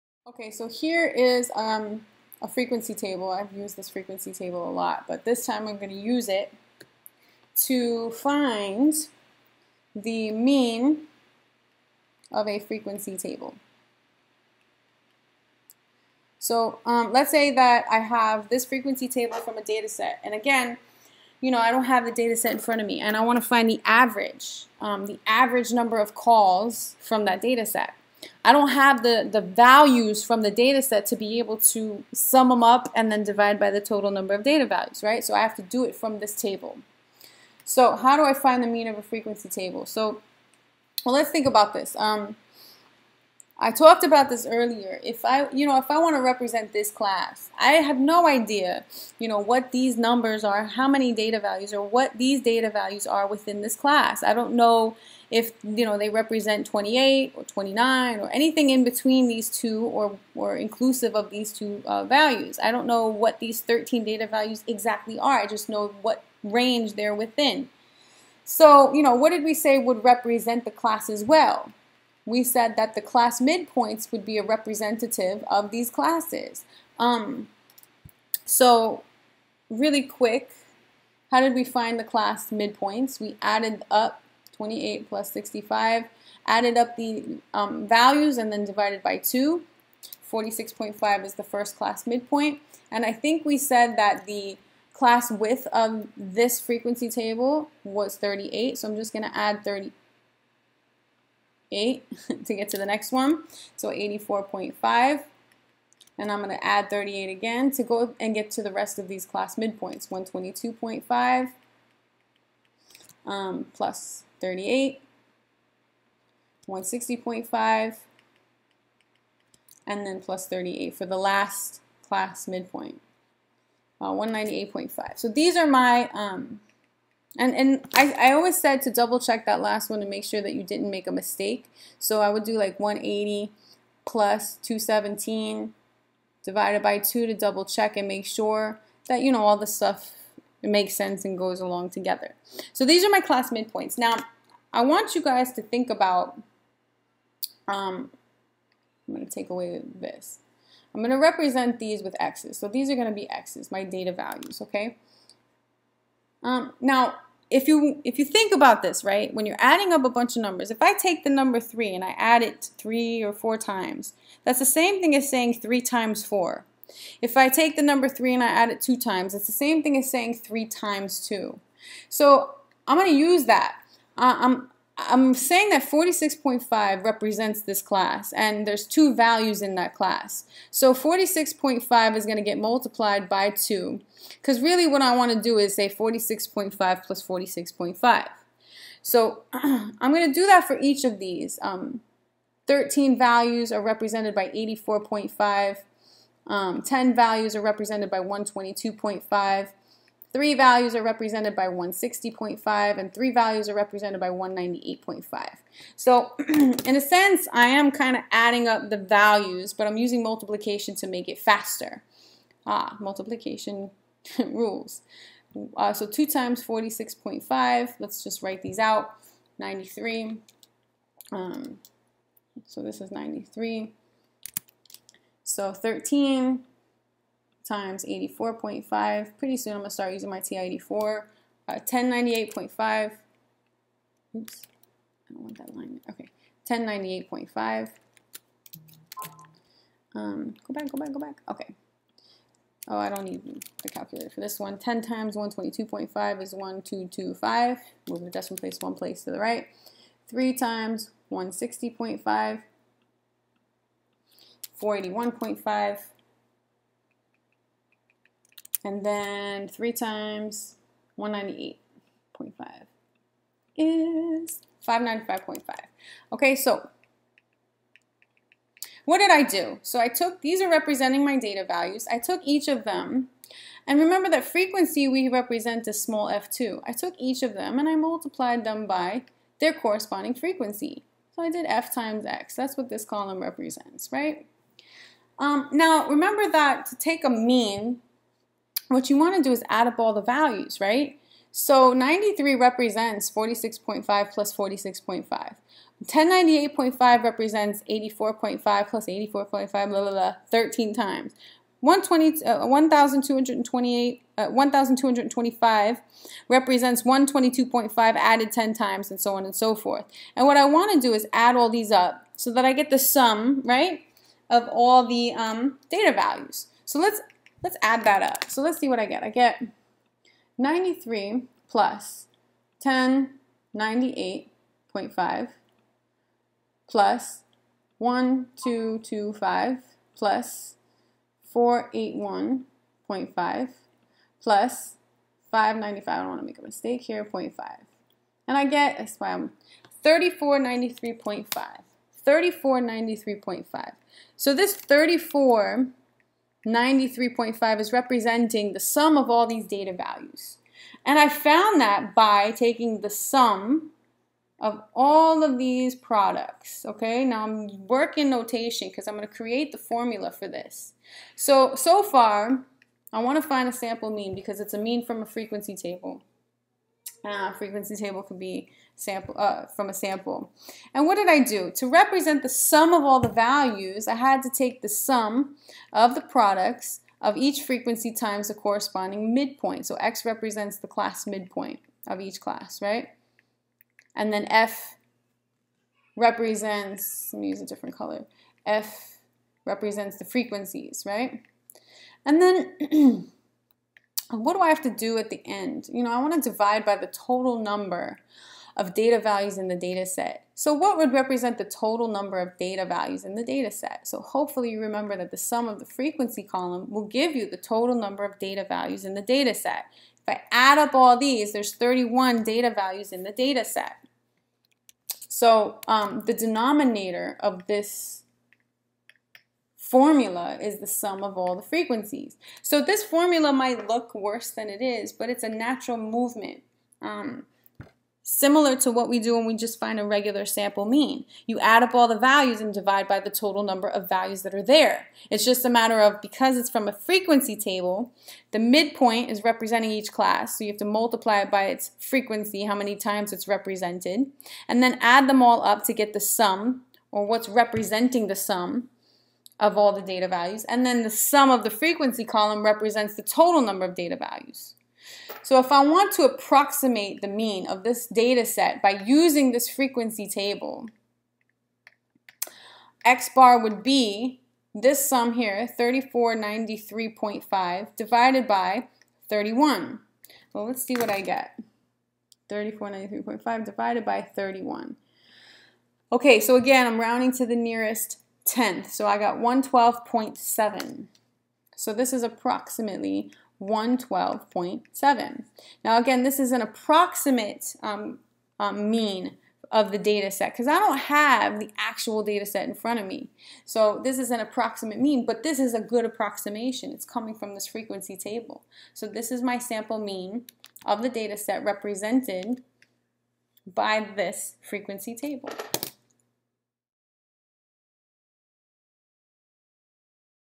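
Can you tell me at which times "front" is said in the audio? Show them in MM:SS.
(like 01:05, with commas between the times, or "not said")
00:22, 08:12.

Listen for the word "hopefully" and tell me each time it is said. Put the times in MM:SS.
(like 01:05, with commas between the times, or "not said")
06:44.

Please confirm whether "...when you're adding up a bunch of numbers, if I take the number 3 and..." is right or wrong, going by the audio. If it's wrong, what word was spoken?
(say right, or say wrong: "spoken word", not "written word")
right.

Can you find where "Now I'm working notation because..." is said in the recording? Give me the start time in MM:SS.
05:57.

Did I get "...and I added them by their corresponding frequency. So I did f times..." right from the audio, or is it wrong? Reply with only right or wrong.
wrong.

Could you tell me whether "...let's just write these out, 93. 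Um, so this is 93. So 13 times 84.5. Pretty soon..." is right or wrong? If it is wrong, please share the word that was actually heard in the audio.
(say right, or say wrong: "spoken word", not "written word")
right.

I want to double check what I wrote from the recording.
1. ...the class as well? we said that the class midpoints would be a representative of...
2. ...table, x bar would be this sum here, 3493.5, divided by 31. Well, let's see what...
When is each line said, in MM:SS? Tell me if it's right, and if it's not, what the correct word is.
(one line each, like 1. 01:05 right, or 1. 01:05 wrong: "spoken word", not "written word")
1. 01:10 right
2. 07:40 right.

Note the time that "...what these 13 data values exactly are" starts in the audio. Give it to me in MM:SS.
01:03.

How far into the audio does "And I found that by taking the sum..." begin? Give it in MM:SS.
05:51.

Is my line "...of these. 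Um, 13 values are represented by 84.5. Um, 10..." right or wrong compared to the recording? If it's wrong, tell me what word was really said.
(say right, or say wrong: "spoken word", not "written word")
right.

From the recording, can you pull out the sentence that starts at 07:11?
You add up all the values and divide by the total number of values that are there.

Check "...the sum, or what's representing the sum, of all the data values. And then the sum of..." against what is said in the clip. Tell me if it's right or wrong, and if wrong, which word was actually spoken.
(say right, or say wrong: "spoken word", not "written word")
right.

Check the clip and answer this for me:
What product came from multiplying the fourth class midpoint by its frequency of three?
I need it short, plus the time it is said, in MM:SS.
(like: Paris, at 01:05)
481.5, at 04:14.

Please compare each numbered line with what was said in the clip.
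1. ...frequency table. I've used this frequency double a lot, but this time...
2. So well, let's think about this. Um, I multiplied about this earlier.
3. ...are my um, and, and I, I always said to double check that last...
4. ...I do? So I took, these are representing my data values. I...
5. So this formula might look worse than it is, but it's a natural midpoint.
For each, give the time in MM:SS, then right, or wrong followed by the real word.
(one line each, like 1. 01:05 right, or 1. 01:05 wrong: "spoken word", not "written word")
1. 00:02 wrong: "table", not "double"
2. 00:39 wrong: "talked", not "multiplied"
3. 02:05 right
4. 04:29 right
5. 07:02 wrong: "movement", not "midpoint".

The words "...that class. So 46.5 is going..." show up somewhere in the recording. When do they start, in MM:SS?
02:59.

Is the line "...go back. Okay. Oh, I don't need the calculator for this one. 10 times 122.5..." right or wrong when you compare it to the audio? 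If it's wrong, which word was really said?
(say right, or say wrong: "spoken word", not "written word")
right.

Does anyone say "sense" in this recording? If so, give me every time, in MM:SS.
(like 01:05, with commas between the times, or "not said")
02:20, 03:27.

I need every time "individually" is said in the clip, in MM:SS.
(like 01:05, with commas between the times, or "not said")
not said.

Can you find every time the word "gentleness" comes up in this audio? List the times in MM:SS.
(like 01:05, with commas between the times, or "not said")
not said.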